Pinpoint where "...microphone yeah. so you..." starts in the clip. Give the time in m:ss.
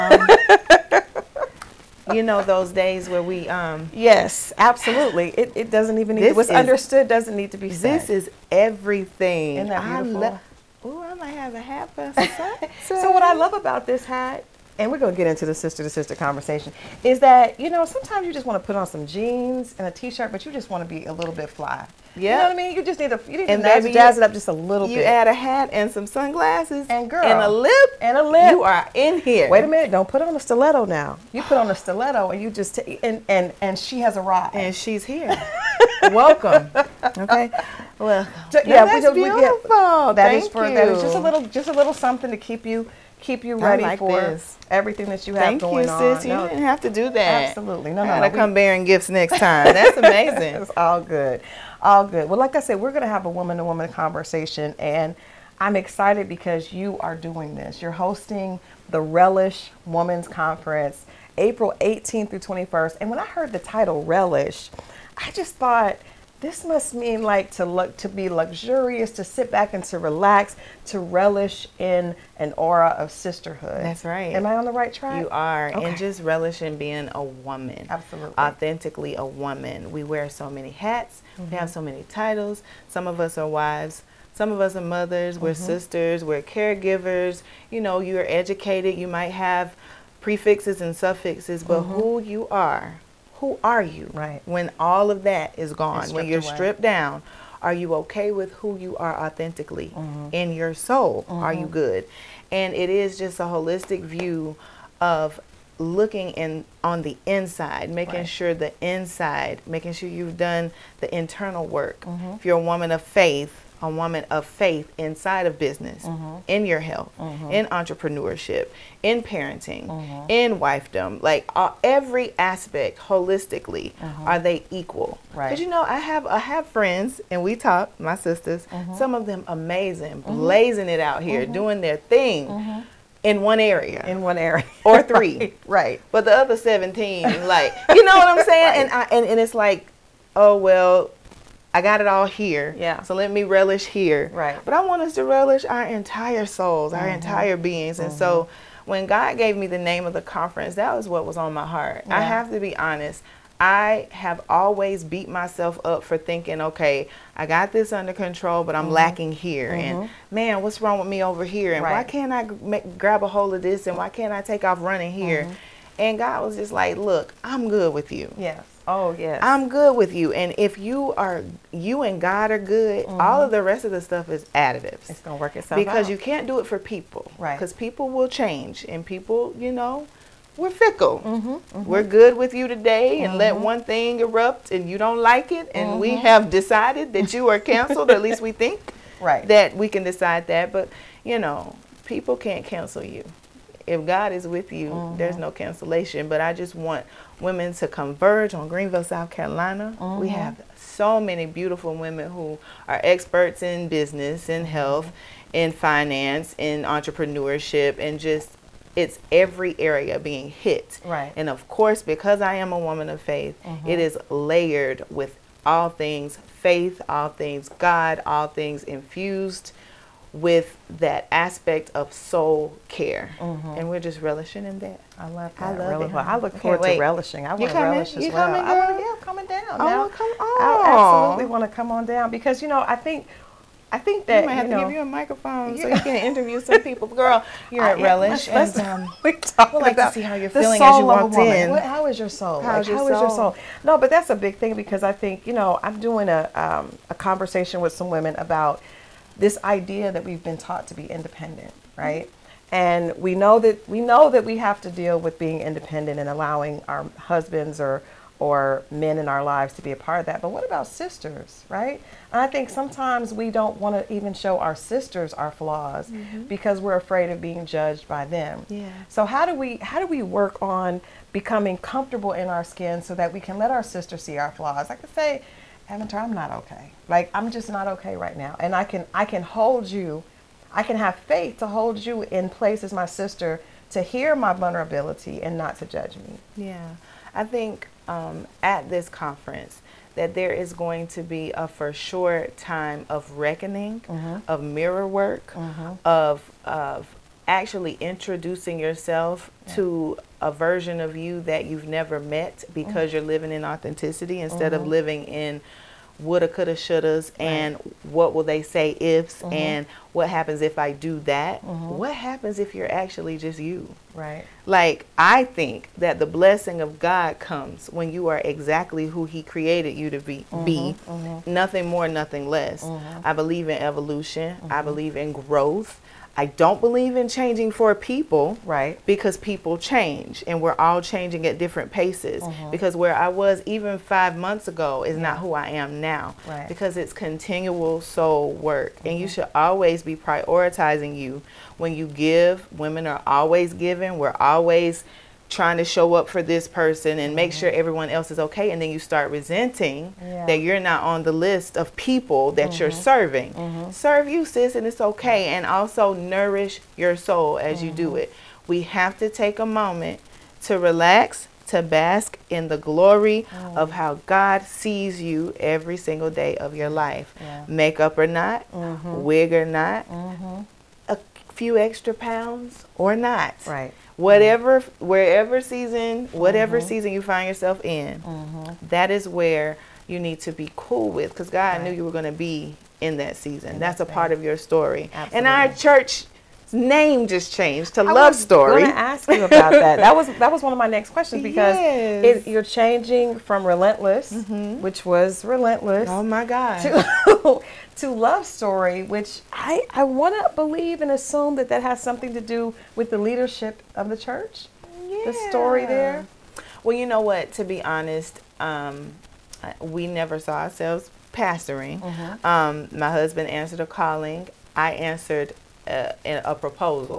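3:55.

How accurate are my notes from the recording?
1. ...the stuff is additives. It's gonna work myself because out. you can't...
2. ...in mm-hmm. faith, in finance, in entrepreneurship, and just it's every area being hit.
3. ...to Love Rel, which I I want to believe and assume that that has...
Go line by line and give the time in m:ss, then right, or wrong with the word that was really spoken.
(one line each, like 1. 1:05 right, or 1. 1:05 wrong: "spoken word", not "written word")
1. 2:53 wrong: "itself", not "myself"
2. 3:24 wrong: "health", not "faith"
3. 6:38 wrong: "Story", not "Rel".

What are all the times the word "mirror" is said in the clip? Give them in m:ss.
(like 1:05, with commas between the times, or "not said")
4:54.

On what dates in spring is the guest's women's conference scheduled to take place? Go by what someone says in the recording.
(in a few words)
April 18th through 21st.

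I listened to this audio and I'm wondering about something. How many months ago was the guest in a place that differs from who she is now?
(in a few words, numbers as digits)
5.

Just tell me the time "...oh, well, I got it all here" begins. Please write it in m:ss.
2:20.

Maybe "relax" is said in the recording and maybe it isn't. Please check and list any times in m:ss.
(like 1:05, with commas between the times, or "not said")
1:09, 6:00.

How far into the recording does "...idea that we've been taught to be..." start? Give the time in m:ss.
4:09.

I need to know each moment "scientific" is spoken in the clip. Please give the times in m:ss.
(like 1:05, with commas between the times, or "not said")
not said.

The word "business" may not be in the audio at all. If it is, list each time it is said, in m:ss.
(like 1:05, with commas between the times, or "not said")
1:55, 3:23.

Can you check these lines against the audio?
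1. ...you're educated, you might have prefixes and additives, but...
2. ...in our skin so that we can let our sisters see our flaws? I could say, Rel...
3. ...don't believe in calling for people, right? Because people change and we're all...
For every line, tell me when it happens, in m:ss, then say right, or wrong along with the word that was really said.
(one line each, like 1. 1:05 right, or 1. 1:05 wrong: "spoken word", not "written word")
1. 1:27 wrong: "suffixes", not "additives"
2. 4:32 wrong: "Aventer", not "Rel"
3. 5:26 wrong: "changing", not "calling".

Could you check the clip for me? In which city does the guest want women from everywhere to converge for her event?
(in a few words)
Greenville, South Carolina.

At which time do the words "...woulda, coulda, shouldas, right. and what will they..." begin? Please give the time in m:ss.
5:06.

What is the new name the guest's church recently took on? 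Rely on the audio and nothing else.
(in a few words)
I Love Story.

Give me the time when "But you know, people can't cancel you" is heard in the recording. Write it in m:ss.
3:10.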